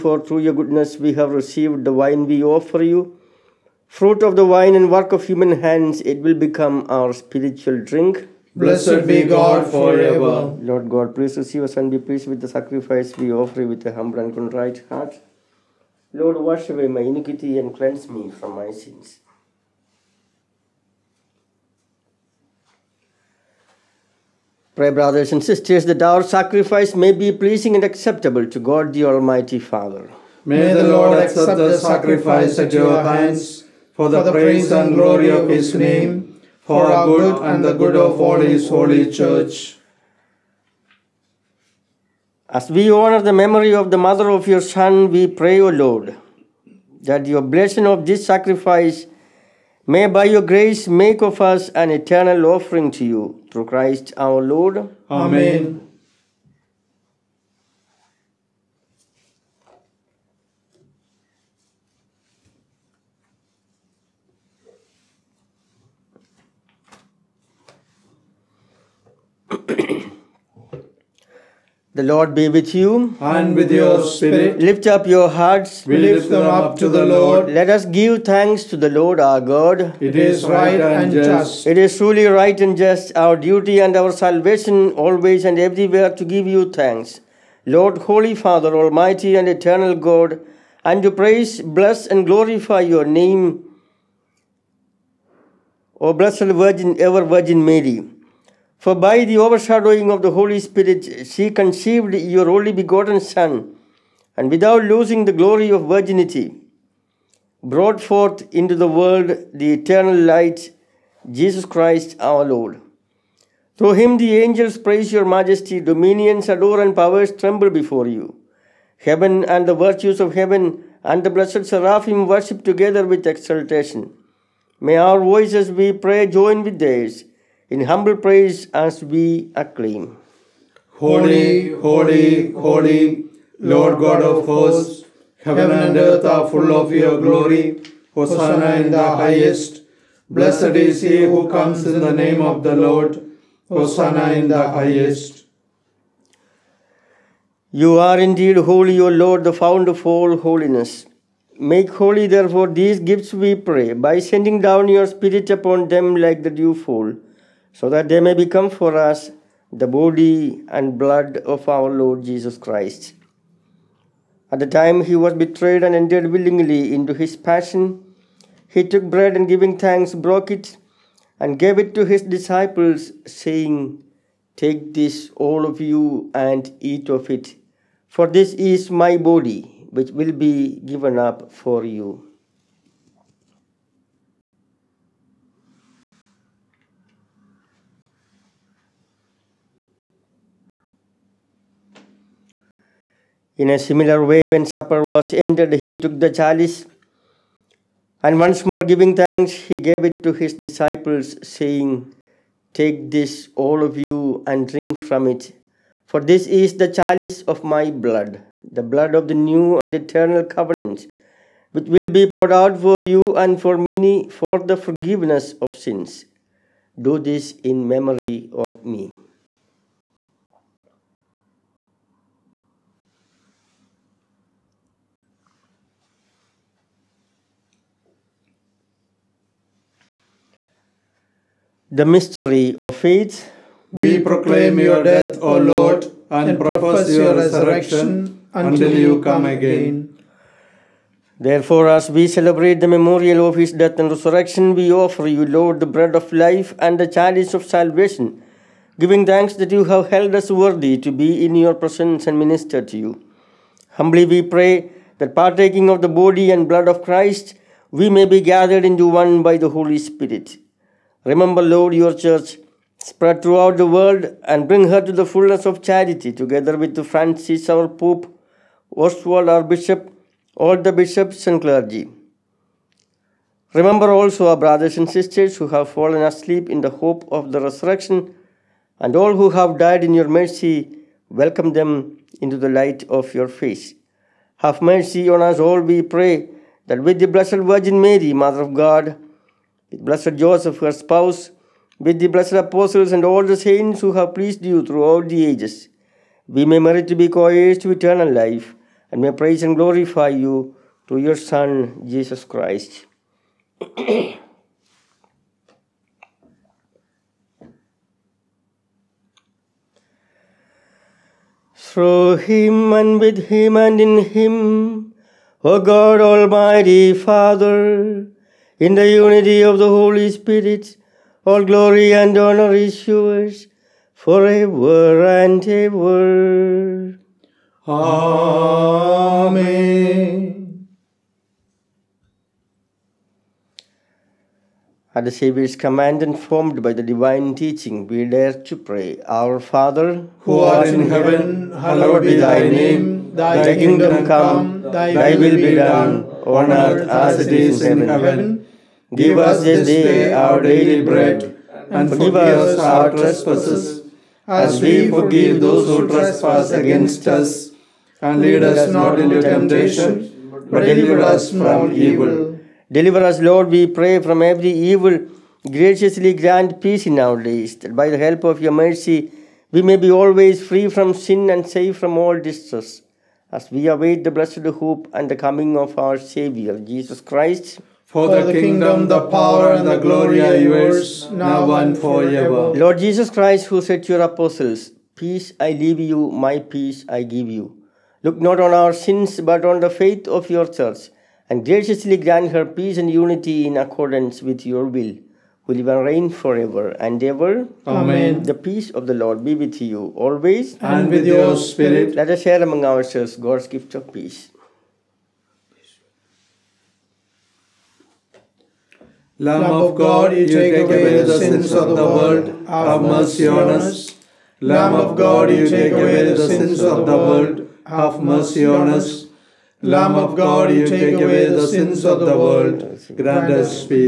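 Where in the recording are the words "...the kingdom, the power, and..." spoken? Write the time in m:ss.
6:18.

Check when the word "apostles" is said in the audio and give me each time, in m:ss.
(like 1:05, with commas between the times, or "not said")
4:52, 6:24.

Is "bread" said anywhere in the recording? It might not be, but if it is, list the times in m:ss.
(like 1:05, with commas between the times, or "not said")
2:49, 4:05, 5:51.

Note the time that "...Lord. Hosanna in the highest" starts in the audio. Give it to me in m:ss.
2:22.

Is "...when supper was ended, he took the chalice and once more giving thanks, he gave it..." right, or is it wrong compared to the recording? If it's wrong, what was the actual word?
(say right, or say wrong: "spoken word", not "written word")
right.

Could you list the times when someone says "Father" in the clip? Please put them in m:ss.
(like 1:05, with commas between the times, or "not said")
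0:29, 1:28, 5:17, 5:39.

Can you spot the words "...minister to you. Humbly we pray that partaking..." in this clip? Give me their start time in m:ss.
4:12.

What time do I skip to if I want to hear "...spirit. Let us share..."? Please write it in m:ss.
6:41.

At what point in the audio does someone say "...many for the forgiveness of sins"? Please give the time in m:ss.
3:33.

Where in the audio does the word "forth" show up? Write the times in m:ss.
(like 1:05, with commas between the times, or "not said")
1:48.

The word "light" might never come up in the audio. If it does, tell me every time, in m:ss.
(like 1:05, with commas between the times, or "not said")
1:50, 4:42.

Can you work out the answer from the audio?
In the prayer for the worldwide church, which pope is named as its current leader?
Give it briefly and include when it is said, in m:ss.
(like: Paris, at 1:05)
Francis, at 4:27.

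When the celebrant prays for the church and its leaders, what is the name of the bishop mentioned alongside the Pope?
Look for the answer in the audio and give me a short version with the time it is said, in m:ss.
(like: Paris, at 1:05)
Oswald, at 4:28.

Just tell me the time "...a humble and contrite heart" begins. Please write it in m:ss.
0:13.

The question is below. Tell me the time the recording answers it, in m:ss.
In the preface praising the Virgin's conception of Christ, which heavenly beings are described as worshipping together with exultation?
2:01.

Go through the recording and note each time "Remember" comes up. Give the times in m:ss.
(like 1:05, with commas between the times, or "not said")
4:21, 4:33.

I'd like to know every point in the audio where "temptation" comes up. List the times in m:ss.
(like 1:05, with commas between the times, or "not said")
5:59.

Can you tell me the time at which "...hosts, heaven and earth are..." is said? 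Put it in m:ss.
2:14.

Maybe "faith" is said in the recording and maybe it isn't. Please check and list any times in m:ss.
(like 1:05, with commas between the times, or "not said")
3:52, 6:29.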